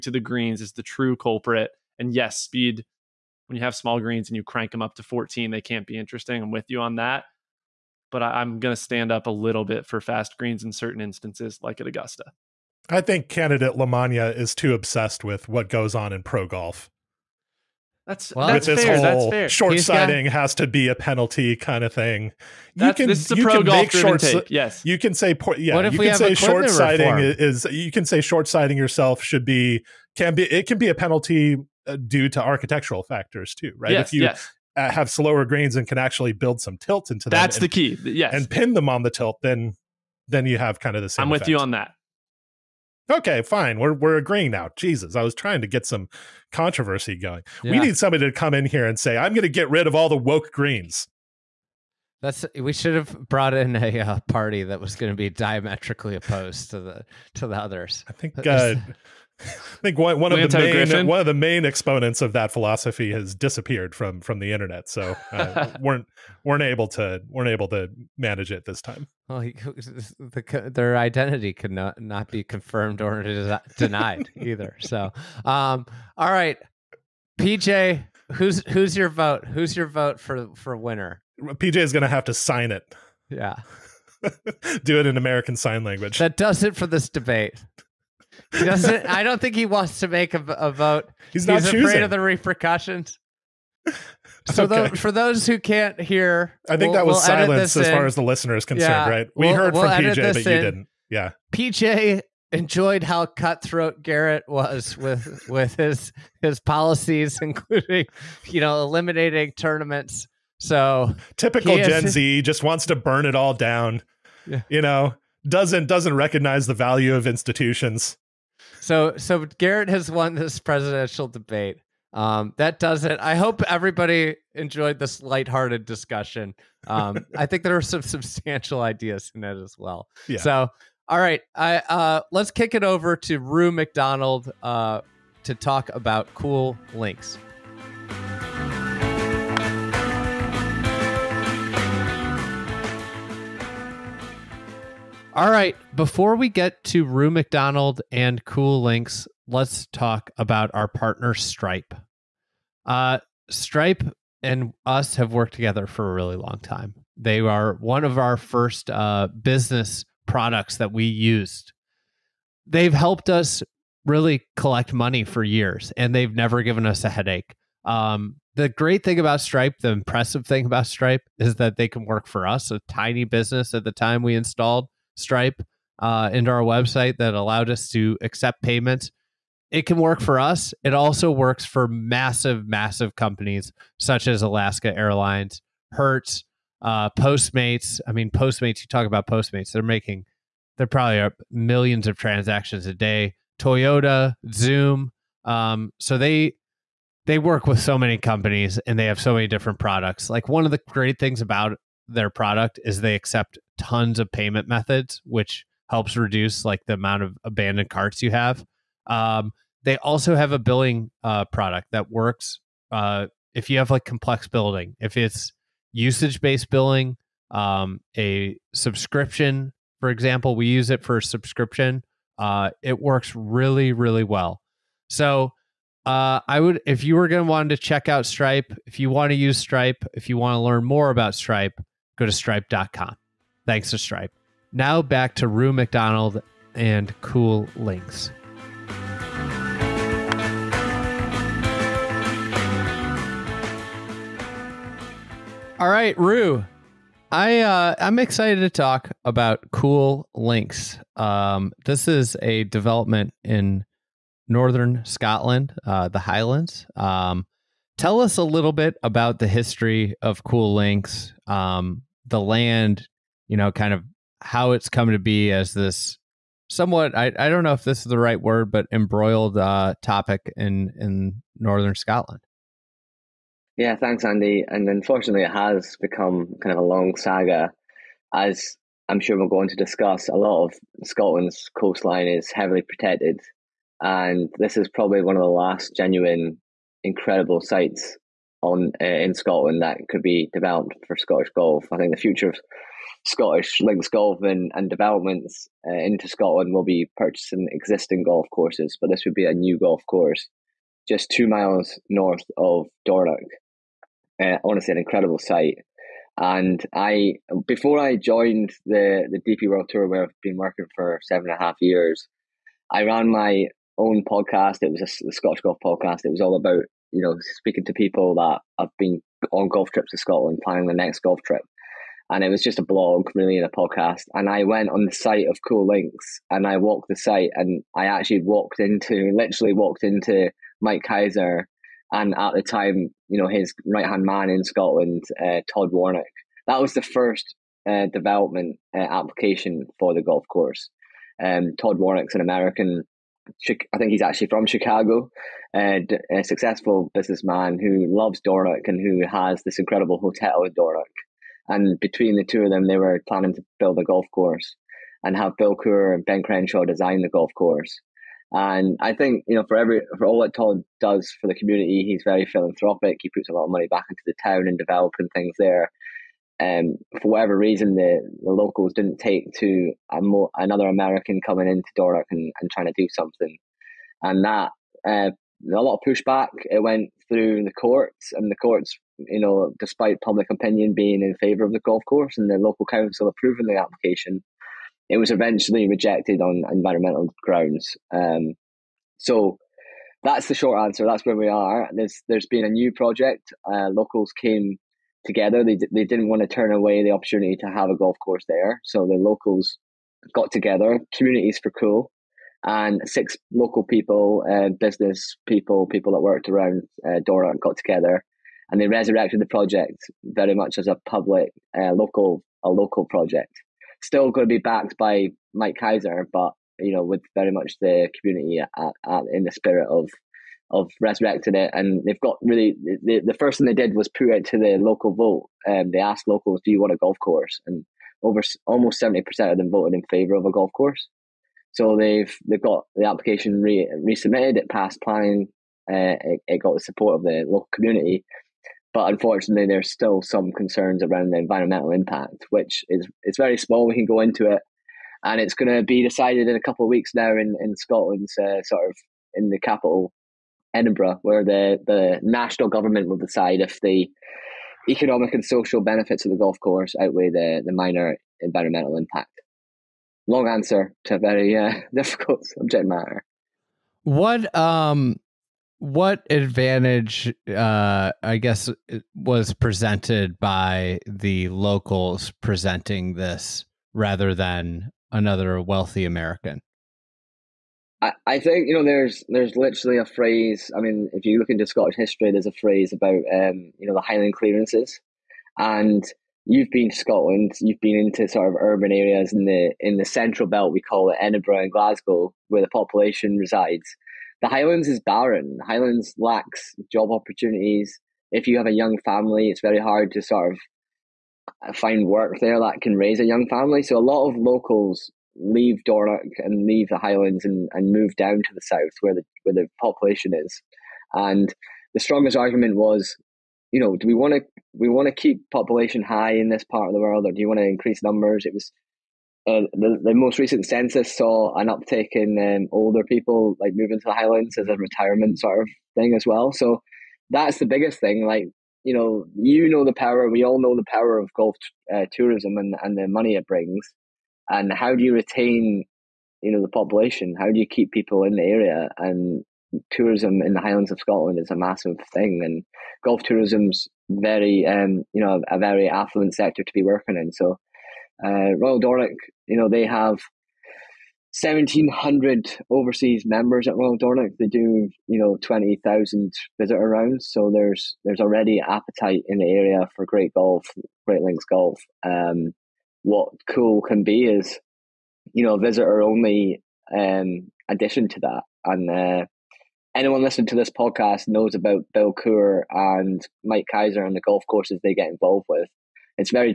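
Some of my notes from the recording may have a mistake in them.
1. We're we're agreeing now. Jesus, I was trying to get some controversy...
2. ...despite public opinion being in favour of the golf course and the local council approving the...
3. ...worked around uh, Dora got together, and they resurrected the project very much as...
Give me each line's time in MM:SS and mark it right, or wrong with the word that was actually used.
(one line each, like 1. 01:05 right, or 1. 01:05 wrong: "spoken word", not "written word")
1. 00:43 right
2. 06:19 right
3. 06:46 right.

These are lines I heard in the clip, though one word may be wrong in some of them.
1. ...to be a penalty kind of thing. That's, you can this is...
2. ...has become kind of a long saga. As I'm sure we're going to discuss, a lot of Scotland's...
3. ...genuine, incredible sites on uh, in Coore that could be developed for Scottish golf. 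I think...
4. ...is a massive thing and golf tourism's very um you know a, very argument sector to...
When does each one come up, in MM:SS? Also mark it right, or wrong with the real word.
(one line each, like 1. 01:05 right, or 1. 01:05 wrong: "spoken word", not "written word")
1. 00:20 right
2. 04:35 right
3. 04:45 wrong: "Scotland", not "Coore"
4. 09:01 wrong: "affluent", not "argument".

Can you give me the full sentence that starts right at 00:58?
I think uh, I think one, one of the main Griffin?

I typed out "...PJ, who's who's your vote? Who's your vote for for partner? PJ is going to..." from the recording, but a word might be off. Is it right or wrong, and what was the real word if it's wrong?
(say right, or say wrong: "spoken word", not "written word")
wrong: "winner", not "partner".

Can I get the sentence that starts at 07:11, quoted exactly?
So they've they've got the application re, resubmitted.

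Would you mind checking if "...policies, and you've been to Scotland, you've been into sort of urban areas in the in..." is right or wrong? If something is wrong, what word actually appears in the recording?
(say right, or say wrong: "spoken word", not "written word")
wrong: "clearances", not "policies".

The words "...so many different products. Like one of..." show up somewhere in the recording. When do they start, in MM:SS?
03:19.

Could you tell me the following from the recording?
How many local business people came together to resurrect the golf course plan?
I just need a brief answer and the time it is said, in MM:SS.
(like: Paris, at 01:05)
6, at 06:43.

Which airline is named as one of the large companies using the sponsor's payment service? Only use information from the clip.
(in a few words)
Alaska Airlines.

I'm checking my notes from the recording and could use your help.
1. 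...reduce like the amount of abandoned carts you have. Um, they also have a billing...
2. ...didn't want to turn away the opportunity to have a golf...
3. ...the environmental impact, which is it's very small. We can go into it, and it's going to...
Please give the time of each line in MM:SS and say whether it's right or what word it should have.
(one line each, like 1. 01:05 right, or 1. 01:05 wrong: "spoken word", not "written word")
1. 03:26 right
2. 06:36 right
3. 07:21 right.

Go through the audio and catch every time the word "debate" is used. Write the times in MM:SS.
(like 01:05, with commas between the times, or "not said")
01:27, 02:01.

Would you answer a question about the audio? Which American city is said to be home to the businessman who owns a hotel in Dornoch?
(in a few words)
Chicago.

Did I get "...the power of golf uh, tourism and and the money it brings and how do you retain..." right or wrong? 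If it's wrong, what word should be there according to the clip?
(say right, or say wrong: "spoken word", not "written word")
right.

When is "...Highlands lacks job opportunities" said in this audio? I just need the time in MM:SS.
08:15.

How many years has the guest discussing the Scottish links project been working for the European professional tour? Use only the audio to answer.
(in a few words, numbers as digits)
7.5 years.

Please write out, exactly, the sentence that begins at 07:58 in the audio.
I, I think you know there's there's literally a phrase.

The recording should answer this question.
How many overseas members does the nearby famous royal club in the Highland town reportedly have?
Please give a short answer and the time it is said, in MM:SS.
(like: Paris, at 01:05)
1700, at 09:11.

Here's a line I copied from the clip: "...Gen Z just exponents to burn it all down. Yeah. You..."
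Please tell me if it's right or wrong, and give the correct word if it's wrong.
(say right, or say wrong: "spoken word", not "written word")
wrong: "wants", not "exponents".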